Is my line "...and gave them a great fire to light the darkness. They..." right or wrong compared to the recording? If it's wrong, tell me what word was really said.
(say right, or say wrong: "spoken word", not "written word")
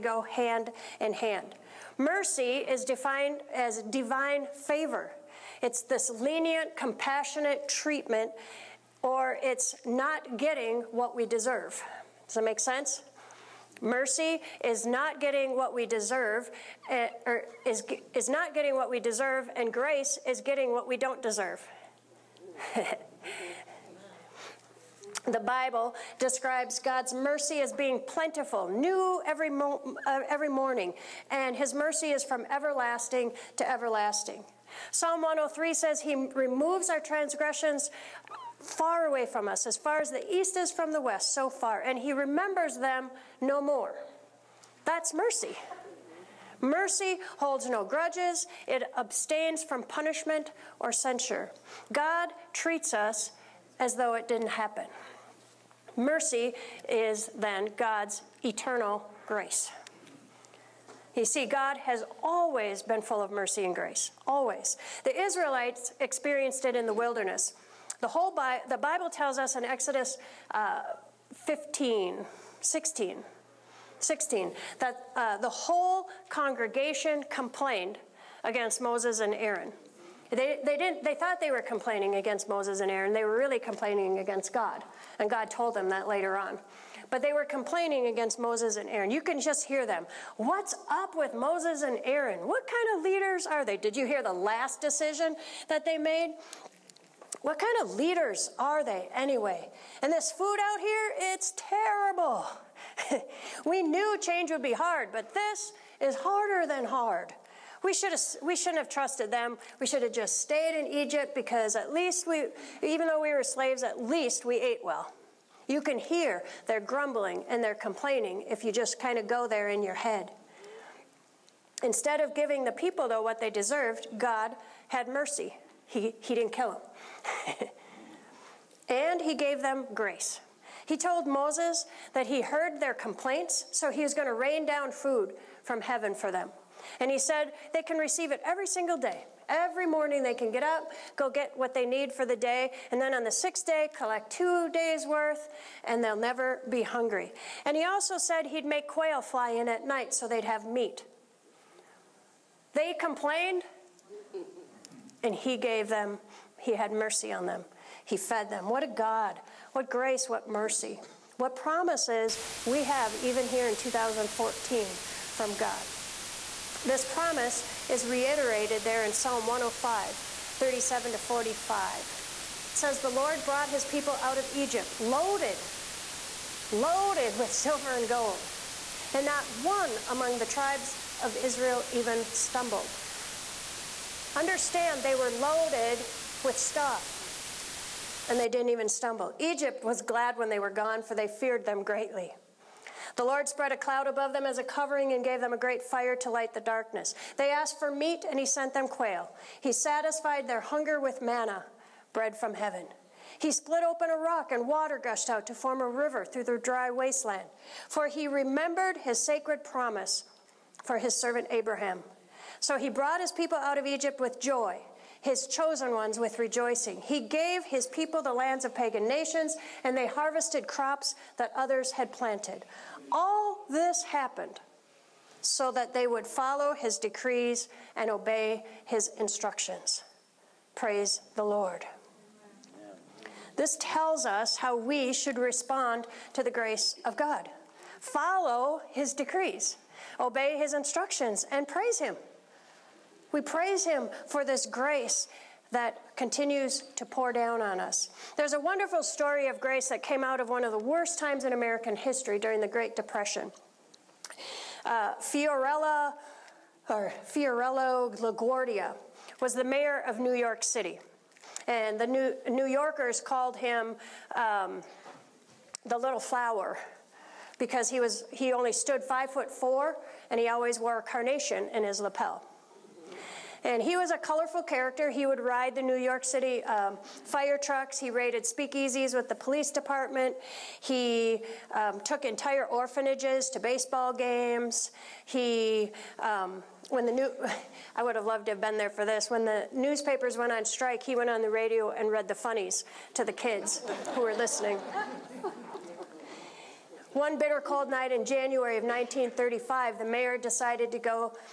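right.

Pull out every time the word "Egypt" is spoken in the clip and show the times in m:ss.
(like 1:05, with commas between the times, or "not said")
1:50, 2:54, 3:09, 3:33.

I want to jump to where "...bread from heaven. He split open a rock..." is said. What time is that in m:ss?
3:22.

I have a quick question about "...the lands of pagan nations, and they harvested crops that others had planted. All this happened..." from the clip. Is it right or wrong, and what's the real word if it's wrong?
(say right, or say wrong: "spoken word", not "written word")
right.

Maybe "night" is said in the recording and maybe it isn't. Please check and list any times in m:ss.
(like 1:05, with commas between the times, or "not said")
2:29, 4:57.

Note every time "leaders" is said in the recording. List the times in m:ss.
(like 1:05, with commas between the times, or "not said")
1:33, 1:37.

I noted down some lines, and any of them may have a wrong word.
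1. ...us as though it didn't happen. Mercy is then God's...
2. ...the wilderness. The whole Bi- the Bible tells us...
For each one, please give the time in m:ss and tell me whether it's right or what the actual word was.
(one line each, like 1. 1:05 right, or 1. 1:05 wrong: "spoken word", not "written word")
1. 0:52 right
2. 1:06 right.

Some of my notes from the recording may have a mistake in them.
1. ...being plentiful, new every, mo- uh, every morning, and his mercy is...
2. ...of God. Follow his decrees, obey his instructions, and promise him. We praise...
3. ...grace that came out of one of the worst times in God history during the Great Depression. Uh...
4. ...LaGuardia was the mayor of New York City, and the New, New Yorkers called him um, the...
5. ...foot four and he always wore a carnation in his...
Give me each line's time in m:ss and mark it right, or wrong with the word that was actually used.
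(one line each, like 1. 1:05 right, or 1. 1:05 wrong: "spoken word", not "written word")
1. 0:27 right
2. 3:57 wrong: "praise", not "promise"
3. 4:09 wrong: "American", not "God"
4. 4:18 right
5. 4:29 right.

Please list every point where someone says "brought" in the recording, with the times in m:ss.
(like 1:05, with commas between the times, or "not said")
2:53, 3:32.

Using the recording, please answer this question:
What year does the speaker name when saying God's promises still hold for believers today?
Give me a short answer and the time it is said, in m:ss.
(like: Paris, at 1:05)
2014, at 2:43.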